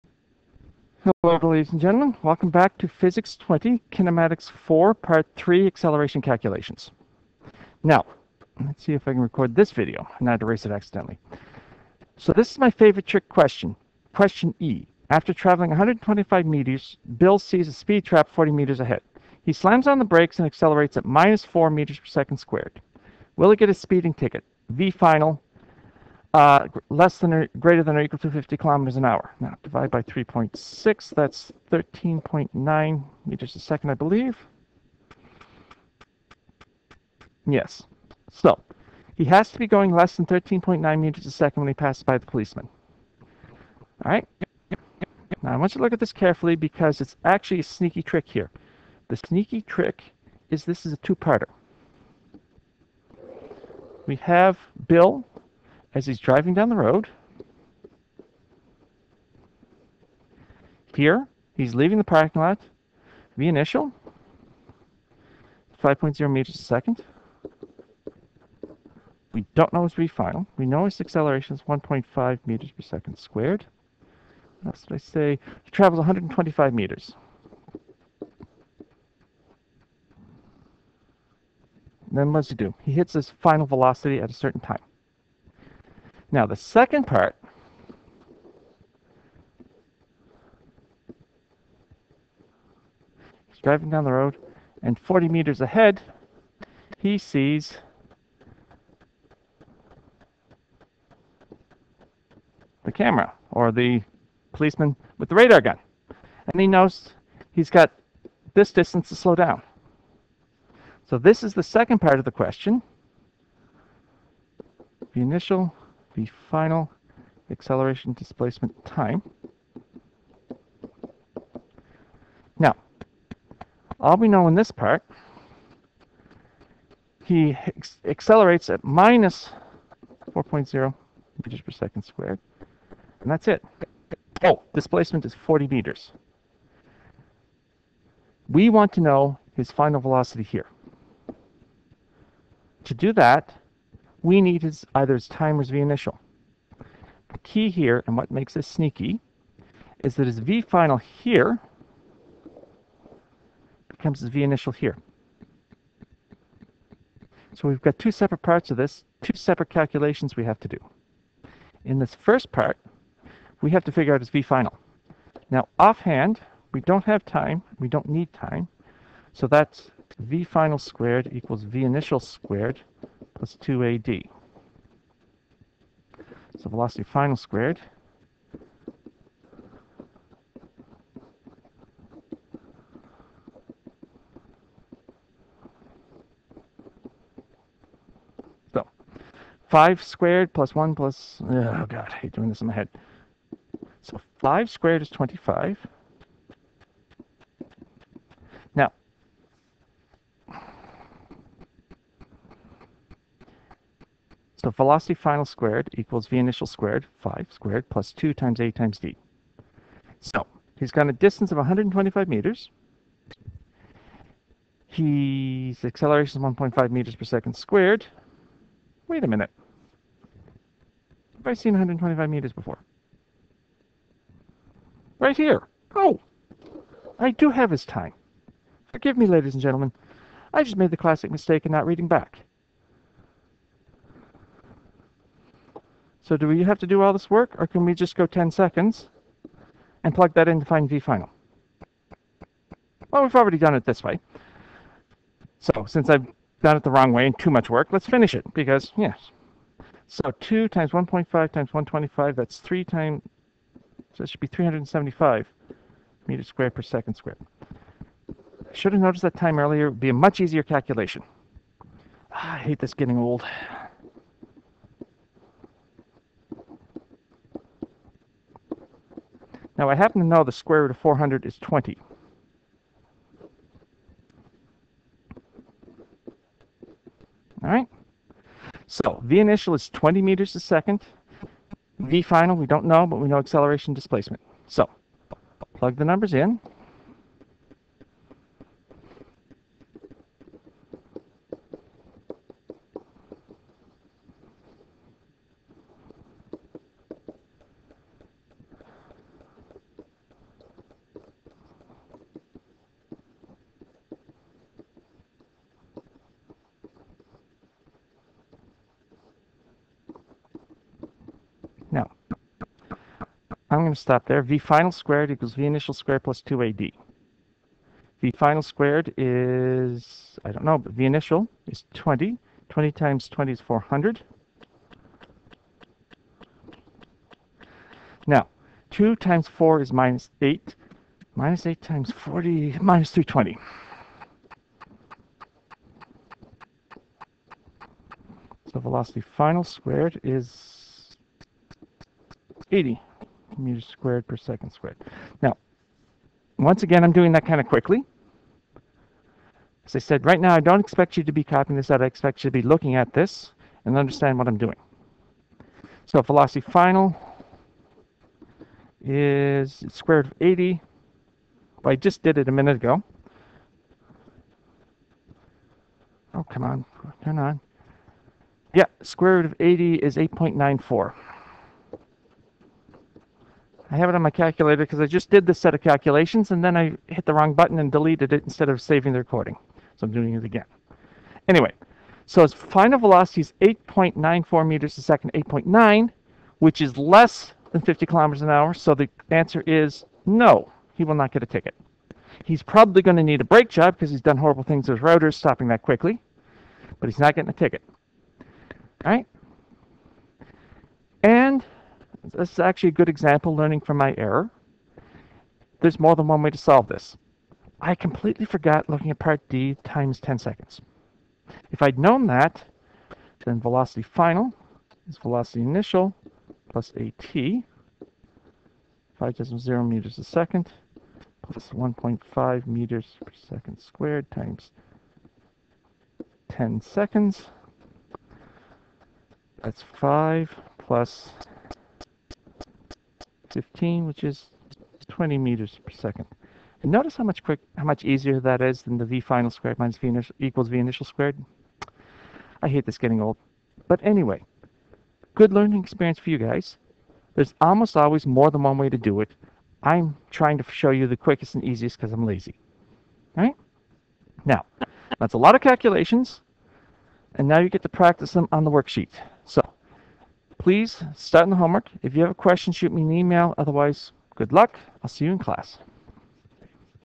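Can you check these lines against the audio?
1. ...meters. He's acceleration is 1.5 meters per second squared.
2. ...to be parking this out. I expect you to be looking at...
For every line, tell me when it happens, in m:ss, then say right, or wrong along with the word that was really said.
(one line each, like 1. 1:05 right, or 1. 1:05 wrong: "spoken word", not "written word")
1. 3:32 right
2. 5:51 wrong: "copying", not "parking".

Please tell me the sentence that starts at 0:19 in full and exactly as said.
He slams on the brakes and accelerates at minus 4 meters per second squared.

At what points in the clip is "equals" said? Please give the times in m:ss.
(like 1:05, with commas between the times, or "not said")
0:28, 2:51, 3:25, 5:15, 7:20.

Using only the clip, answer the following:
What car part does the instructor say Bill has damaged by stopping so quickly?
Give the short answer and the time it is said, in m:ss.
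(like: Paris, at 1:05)
Rotors, at 6:35.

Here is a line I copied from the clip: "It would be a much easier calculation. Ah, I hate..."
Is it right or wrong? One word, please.
right.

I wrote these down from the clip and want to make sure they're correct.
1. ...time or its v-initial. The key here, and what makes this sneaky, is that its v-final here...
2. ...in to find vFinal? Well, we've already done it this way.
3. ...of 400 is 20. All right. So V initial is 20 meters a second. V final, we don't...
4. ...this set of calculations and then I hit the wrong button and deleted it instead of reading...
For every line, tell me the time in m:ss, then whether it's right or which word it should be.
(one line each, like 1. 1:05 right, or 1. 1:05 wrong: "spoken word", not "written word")
1. 2:25 right
2. 4:00 right
3. 4:30 right
4. 6:15 wrong: "saving", not "reading".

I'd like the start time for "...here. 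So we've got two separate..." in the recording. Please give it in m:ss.
2:34.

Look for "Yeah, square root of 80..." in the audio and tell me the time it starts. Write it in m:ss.
6:08.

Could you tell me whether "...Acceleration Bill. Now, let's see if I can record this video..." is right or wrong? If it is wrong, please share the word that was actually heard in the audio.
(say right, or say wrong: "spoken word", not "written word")
wrong: "Calculations", not "Bill".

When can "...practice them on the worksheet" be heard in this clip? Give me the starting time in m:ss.
7:37.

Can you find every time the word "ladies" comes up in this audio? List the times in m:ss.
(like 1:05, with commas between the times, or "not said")
0:01, 3:49.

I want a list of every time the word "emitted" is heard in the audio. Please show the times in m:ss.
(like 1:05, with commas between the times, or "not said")
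not said.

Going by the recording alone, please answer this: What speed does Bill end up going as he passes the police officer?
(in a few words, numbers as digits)
8.94 meters per second.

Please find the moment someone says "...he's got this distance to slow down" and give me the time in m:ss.
1:47.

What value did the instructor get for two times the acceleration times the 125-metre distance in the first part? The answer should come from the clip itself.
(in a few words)
375.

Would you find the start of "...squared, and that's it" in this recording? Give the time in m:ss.
2:12.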